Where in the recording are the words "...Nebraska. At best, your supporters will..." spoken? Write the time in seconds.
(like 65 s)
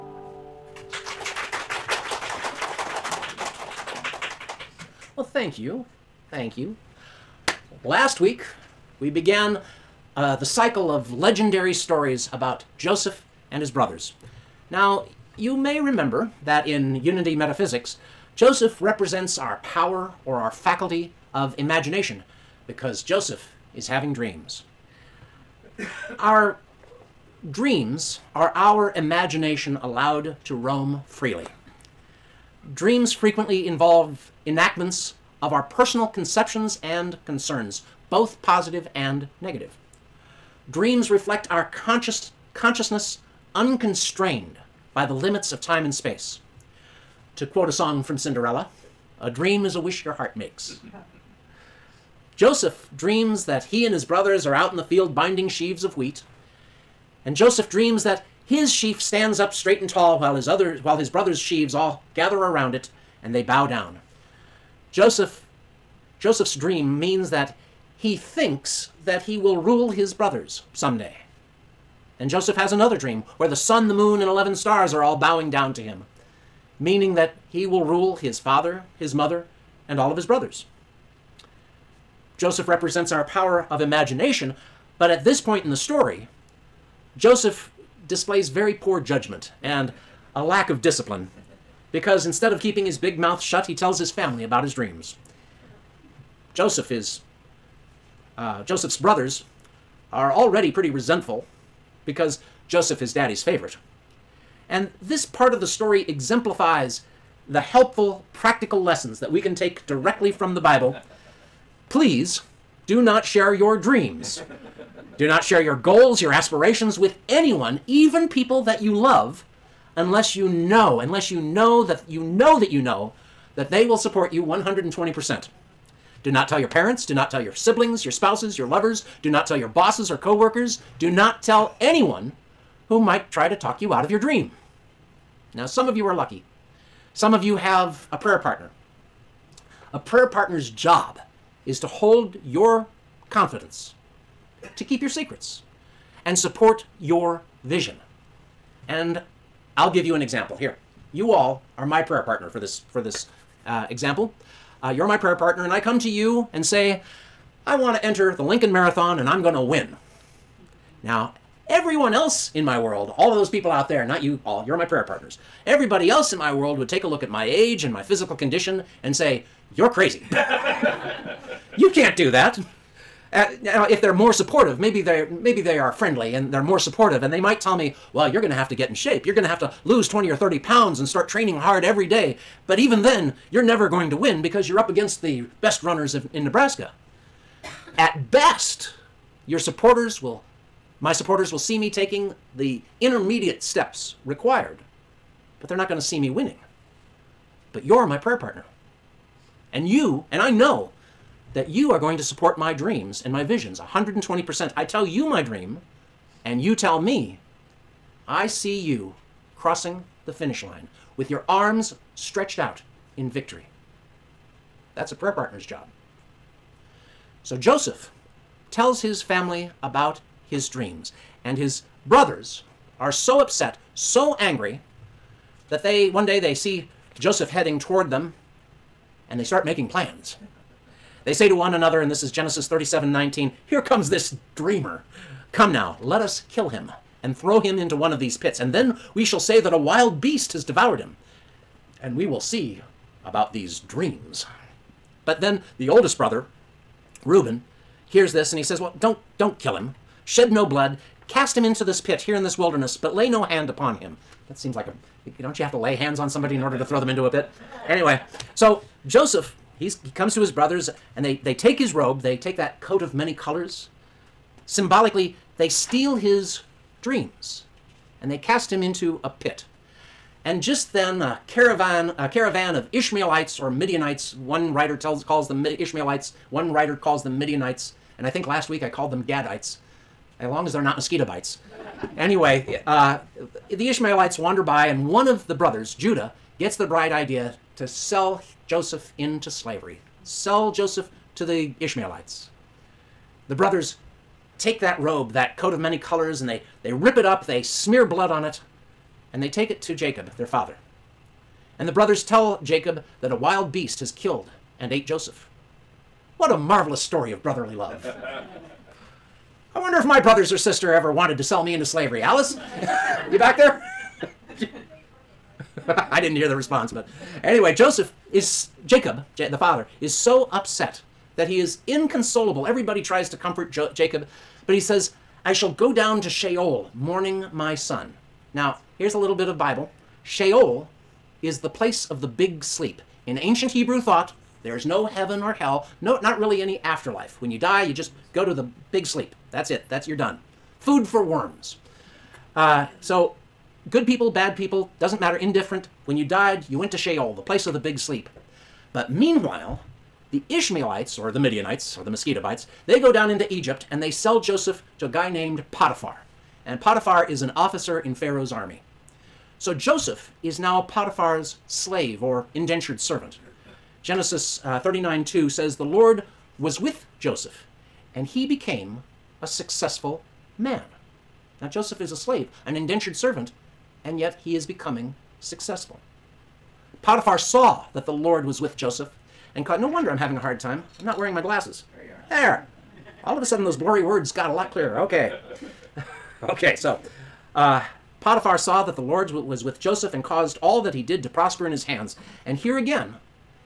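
186 s.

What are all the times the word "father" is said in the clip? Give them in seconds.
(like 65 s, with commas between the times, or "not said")
78 s, 300 s, 319 s.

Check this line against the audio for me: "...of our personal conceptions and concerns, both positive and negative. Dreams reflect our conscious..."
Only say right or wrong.
right.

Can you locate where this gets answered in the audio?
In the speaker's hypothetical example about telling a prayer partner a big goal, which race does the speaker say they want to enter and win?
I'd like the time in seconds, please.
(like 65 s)
158 s.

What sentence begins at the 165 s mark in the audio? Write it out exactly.
Everybody else in my world would take a look at my age and my physical condition and say, You're crazy.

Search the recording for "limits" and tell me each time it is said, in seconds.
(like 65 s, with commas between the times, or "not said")
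45 s.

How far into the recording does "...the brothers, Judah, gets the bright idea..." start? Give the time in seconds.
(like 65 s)
285 s.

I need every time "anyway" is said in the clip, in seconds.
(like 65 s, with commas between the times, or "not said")
257 s, 282 s, 317 s.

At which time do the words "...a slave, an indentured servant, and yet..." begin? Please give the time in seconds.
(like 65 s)
372 s.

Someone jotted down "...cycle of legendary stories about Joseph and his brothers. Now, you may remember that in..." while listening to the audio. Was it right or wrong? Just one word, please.
right.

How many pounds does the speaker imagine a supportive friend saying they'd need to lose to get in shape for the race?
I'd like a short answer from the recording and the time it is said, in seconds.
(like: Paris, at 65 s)
20 or 30, at 180 s.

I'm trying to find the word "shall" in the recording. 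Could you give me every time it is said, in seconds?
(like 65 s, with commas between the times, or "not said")
239 s, 325 s.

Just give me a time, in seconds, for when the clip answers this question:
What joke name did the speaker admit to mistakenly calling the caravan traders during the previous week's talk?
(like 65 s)
279 s.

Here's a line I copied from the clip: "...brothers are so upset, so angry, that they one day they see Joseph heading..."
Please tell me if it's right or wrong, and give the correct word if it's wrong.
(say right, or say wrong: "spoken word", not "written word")
right.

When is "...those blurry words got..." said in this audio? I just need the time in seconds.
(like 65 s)
383 s.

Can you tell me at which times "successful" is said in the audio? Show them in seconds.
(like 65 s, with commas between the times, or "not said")
369 s, 375 s.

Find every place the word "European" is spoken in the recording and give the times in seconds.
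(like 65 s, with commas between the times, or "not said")
not said.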